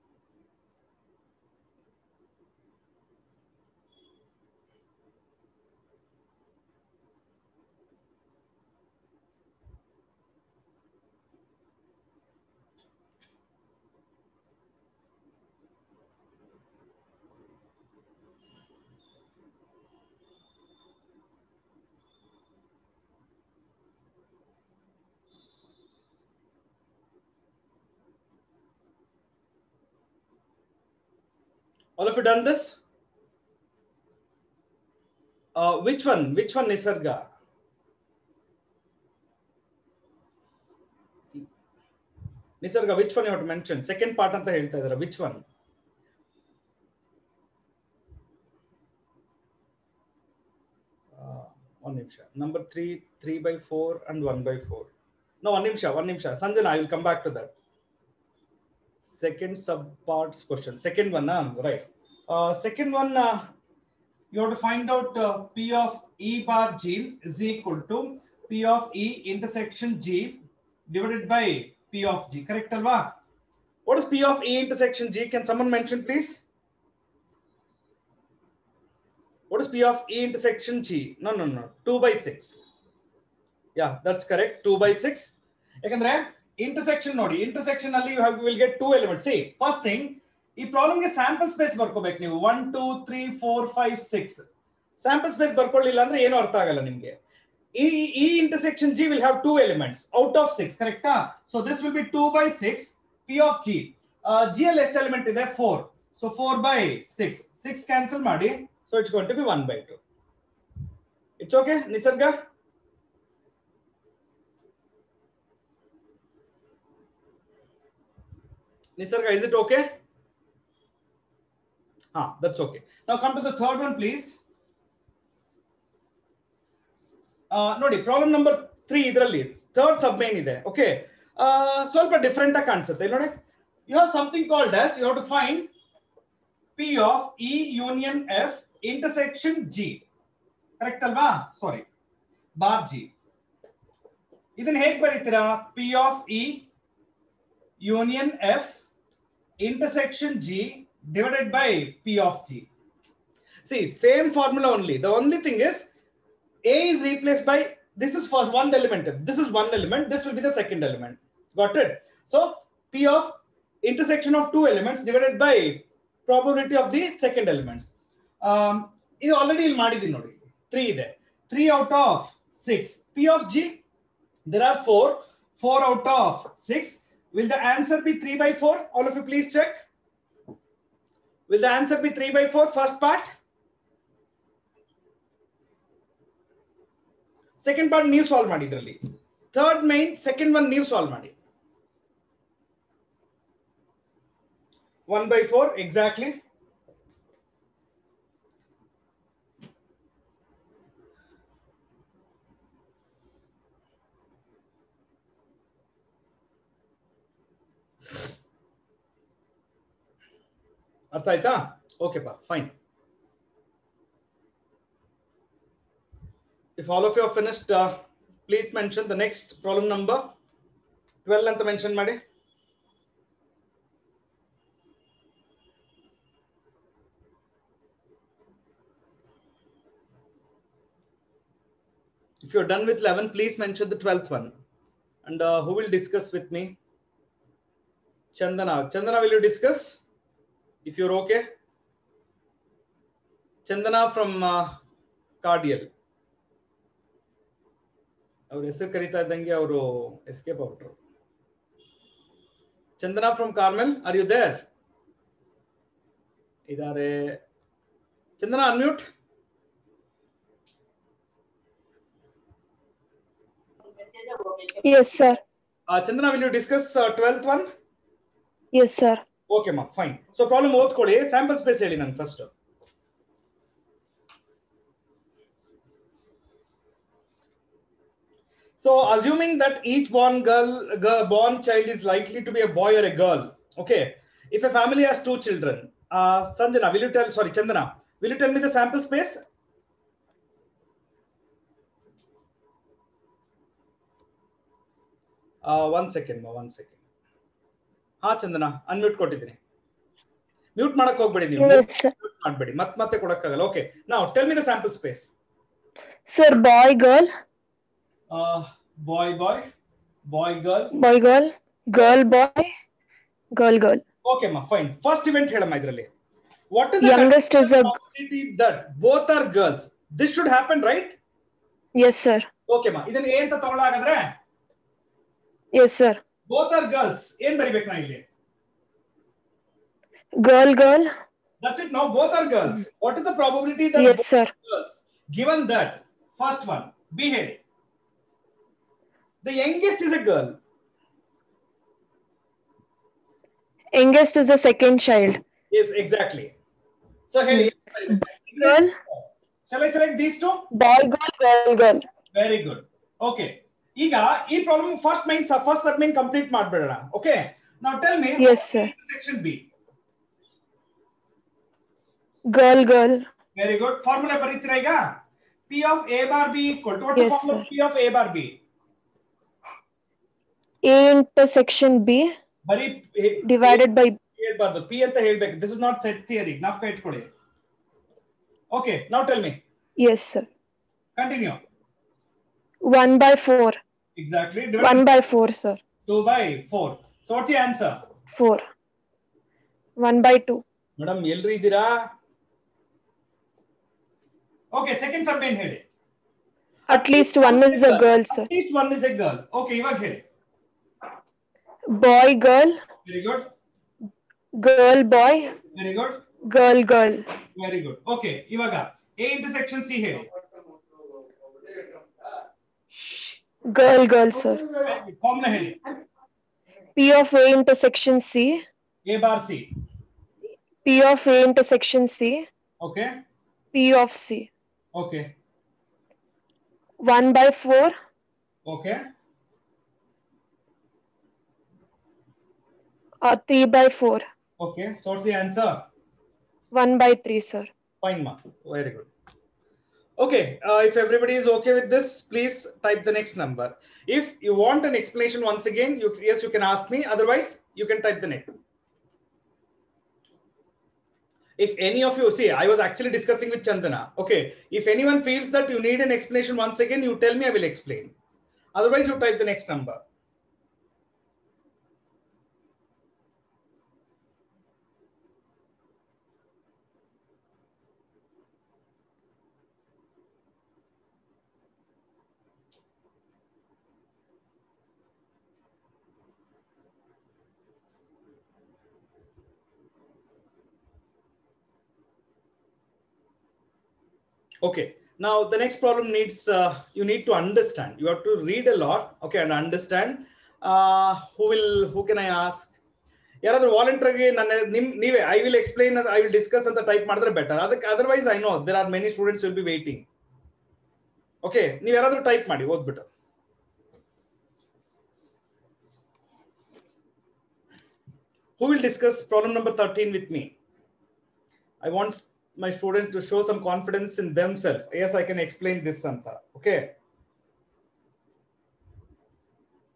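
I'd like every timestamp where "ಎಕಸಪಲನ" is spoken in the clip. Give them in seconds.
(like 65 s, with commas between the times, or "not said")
495 s.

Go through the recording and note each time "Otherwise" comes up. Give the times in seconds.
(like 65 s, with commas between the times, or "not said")
447 s, 458 s.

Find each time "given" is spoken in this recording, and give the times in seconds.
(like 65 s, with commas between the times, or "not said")
335 s.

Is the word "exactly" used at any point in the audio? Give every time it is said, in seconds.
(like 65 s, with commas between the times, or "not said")
195 s, 346 s, 384 s.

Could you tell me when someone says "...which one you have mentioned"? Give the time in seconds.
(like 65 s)
42 s.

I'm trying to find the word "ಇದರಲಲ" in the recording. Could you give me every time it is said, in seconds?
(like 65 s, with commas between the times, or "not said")
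129 s, 315 s.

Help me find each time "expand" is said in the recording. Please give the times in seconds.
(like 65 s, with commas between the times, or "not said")
not said.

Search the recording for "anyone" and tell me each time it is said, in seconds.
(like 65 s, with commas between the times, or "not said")
454 s.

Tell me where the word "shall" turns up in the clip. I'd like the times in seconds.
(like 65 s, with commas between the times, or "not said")
349 s.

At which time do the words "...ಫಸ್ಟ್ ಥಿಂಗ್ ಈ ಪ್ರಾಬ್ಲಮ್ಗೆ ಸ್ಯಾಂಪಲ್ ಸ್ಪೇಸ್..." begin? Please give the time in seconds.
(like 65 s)
89 s.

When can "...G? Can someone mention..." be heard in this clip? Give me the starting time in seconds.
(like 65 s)
75 s.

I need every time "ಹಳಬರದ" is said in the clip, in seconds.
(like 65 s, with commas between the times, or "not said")
374 s.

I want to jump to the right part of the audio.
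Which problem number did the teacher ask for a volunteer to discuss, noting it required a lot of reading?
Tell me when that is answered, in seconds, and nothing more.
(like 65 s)
509 s.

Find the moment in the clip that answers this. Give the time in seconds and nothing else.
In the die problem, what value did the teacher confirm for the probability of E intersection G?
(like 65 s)
81 s.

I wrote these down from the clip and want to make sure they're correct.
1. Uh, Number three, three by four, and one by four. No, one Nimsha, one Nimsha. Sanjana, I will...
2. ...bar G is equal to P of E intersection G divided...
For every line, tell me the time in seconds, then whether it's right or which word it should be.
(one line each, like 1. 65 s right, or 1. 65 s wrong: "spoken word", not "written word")
1. 51 s right
2. 66 s right.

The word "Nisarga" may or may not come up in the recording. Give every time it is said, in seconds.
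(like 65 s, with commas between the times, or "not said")
36 s, 42 s, 118 s.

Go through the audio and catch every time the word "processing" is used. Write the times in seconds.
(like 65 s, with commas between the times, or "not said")
not said.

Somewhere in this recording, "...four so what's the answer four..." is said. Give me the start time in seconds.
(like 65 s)
386 s.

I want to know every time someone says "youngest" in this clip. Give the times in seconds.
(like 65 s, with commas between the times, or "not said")
339 s, 343 s.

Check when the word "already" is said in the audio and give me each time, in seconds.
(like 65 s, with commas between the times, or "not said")
169 s.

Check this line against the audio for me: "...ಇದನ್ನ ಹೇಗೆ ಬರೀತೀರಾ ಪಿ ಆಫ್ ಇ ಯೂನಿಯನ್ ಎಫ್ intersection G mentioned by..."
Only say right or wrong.
wrong.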